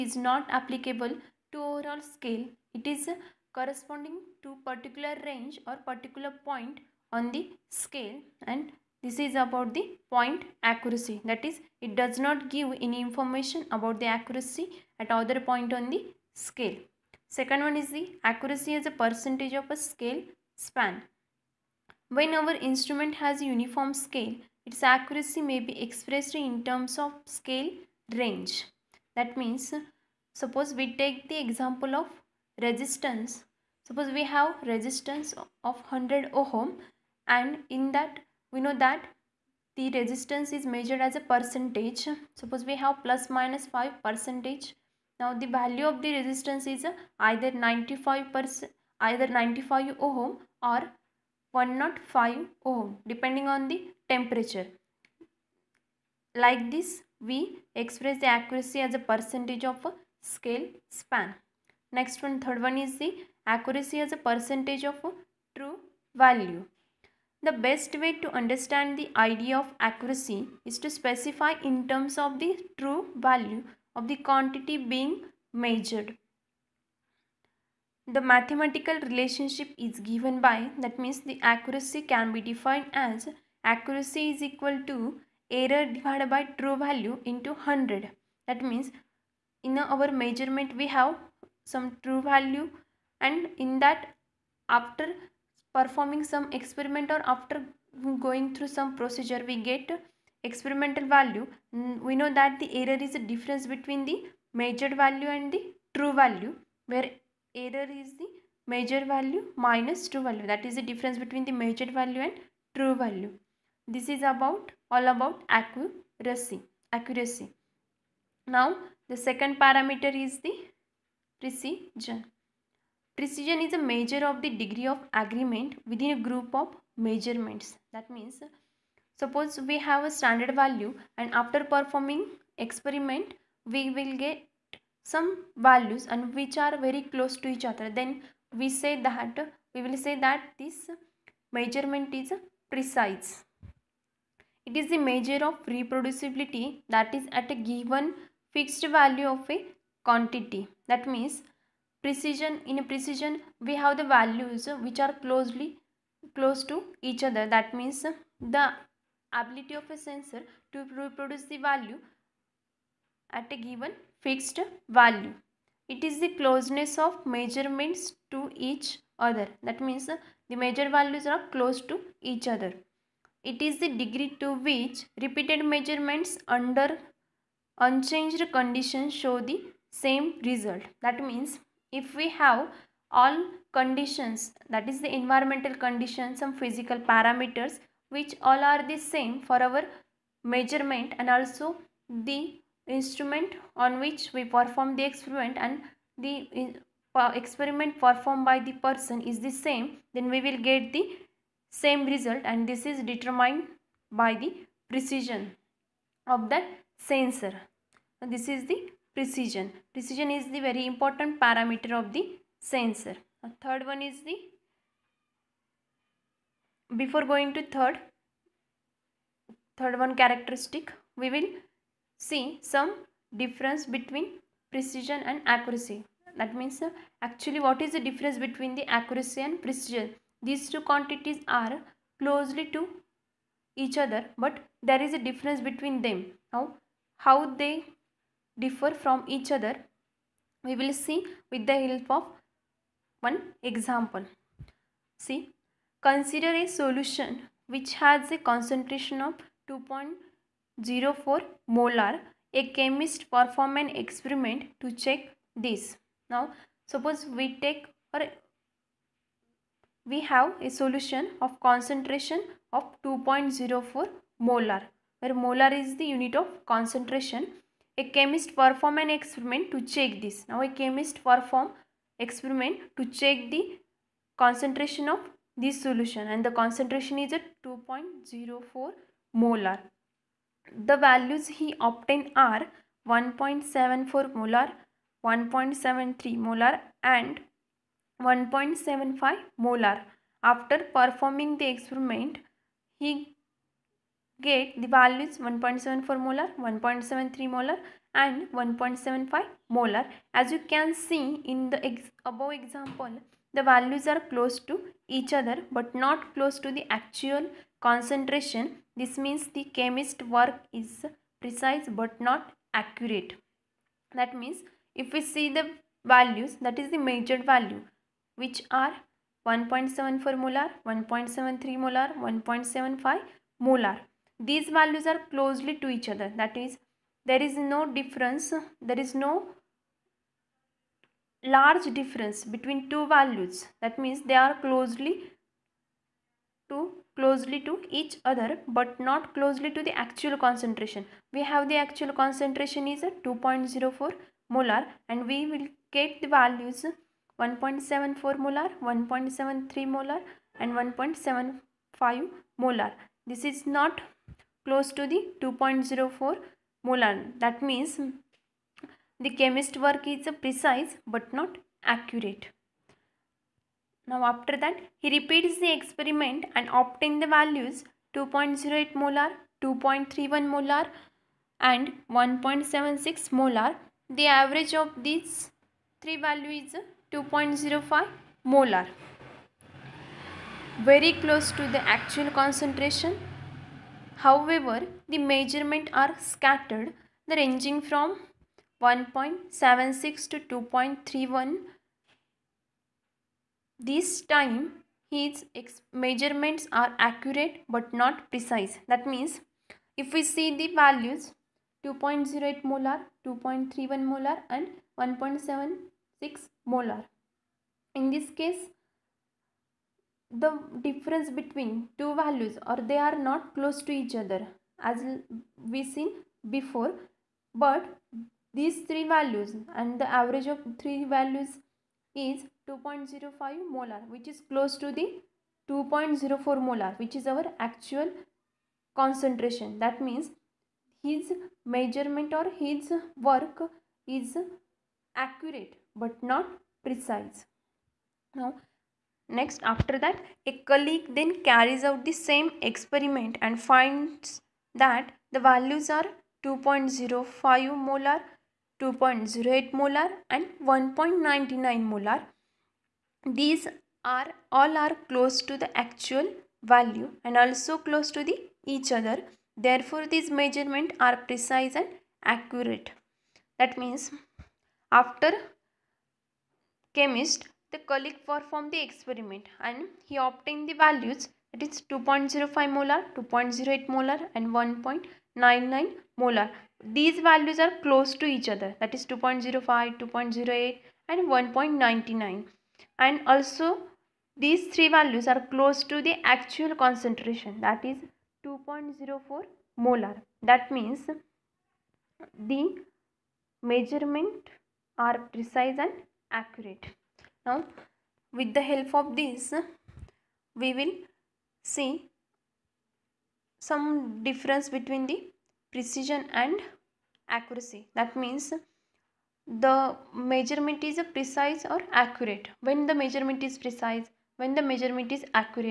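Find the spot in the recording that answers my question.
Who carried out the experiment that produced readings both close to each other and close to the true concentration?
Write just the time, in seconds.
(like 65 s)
440 s.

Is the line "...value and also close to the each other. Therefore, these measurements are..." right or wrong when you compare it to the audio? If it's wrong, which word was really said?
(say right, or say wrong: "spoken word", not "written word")
right.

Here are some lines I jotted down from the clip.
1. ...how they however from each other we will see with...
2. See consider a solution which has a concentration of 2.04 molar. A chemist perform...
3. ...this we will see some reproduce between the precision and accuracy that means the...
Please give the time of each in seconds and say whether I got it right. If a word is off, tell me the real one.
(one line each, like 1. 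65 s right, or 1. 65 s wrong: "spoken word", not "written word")
1. 237 s wrong: "differ", not "however"
2. 245 s right
3. 499 s wrong: "difference", not "reproduce".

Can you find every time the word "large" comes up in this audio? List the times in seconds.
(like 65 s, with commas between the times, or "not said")
331 s.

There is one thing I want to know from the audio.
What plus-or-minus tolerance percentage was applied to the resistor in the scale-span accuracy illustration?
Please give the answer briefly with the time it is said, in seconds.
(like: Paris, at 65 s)
5 percent, at 43 s.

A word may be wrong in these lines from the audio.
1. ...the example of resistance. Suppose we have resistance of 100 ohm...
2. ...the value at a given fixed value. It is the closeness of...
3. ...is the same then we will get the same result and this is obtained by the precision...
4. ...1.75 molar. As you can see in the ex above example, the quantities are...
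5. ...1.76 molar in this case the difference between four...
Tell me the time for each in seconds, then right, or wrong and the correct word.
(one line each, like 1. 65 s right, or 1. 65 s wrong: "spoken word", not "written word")
1. 31 s right
2. 161 s right
3. 199 s wrong: "determined", not "obtained"
4. 298 s wrong: "values", not "quantities"
5. 405 s wrong: "two", not "four".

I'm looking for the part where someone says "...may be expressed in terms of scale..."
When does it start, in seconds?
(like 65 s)
25 s.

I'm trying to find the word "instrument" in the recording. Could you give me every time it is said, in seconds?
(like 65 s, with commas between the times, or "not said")
22 s, 192 s.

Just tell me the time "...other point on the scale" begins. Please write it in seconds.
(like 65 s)
15 s.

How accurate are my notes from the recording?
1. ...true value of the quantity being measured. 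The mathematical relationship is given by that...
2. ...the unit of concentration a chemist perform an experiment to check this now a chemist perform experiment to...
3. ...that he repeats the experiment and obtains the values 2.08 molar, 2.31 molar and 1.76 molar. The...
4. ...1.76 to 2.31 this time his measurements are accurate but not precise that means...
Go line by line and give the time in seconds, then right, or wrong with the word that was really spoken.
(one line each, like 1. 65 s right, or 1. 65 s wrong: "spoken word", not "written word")
1. 72 s right
2. 265 s right
3. 364 s right
4. 388 s right.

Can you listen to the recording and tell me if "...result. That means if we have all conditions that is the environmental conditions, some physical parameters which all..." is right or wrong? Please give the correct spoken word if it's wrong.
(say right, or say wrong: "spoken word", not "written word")
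right.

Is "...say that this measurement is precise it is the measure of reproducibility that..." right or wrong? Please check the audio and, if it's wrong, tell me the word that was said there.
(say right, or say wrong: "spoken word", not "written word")
right.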